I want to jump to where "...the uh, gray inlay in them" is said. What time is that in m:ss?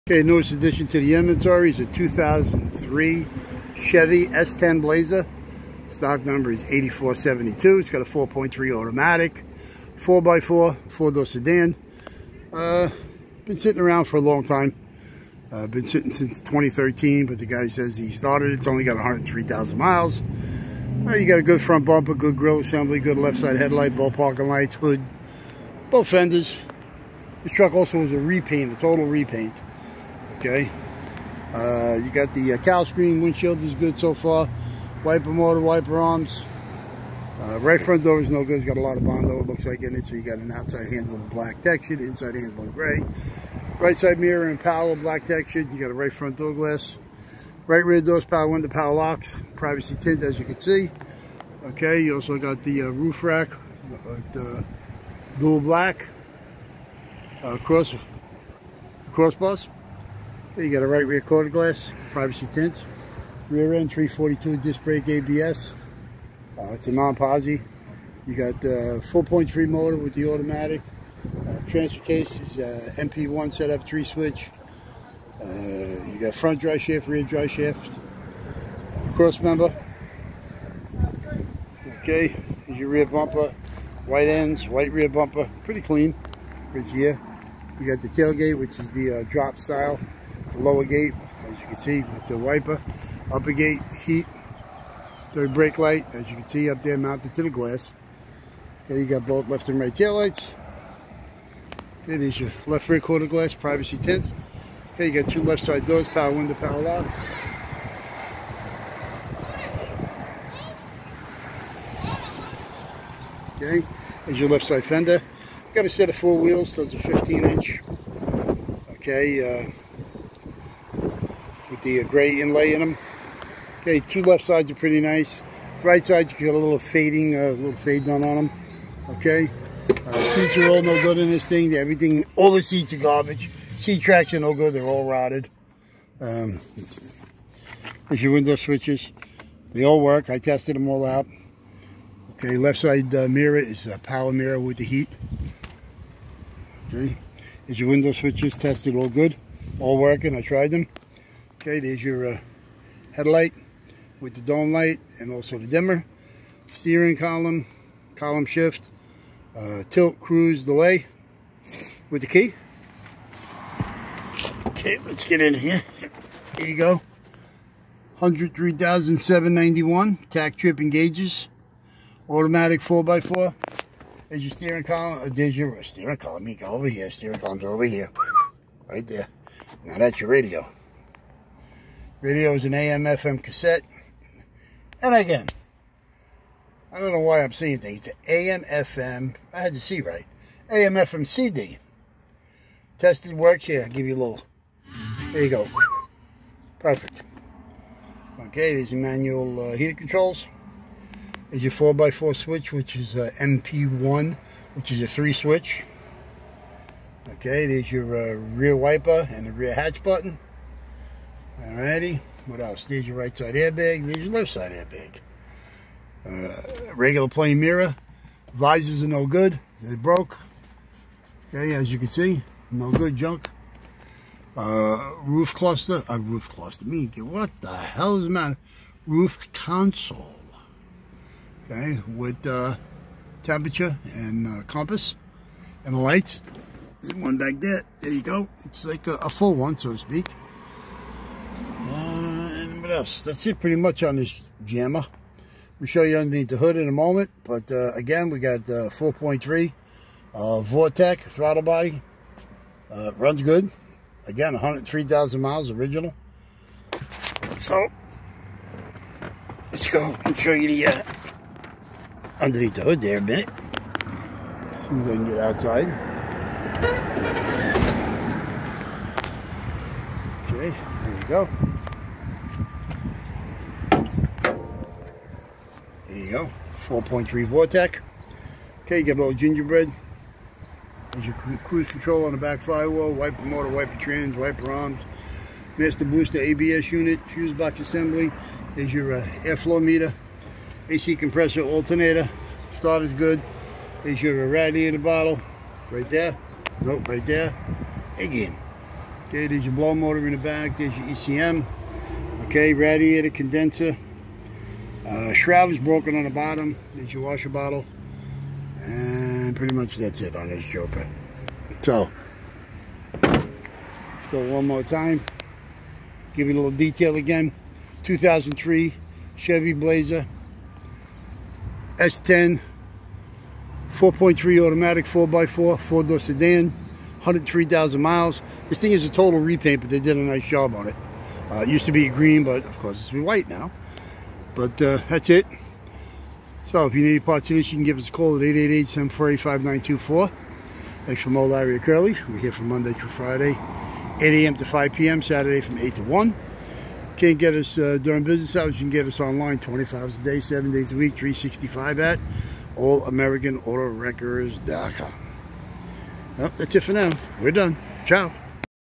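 2:02.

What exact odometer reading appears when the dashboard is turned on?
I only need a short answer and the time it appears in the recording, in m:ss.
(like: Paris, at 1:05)
103,791, at 2:48.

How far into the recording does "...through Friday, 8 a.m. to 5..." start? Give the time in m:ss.
5:42.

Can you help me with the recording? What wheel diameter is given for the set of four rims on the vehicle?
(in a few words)
15 inch.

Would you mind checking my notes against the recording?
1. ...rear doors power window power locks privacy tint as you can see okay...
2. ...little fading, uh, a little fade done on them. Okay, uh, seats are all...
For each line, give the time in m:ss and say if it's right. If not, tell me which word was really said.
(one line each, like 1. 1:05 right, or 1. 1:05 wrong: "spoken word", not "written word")
1. 0:47 right
2. 2:06 right.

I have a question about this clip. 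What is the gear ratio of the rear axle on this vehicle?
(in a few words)
342.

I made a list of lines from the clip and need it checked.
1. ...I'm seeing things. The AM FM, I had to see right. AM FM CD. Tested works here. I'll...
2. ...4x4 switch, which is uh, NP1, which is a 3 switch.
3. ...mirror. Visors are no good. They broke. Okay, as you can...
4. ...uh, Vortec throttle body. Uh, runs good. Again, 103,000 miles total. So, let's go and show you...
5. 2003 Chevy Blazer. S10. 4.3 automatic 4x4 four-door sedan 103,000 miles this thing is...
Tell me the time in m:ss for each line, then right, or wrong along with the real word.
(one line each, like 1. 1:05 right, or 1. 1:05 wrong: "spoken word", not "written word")
1. 3:07 right
2. 3:21 right
3. 3:37 right
4. 4:10 wrong: "original", not "total"
5. 5:18 right.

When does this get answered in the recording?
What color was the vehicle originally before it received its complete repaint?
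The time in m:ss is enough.
5:32.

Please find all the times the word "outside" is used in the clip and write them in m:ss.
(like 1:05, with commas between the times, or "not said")
0:40, 4:25.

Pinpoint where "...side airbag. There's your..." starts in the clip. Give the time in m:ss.
3:33.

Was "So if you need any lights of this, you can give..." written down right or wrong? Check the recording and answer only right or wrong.
wrong.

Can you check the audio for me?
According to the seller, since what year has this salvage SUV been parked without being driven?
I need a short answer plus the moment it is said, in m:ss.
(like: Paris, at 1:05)
2013, at 0:16.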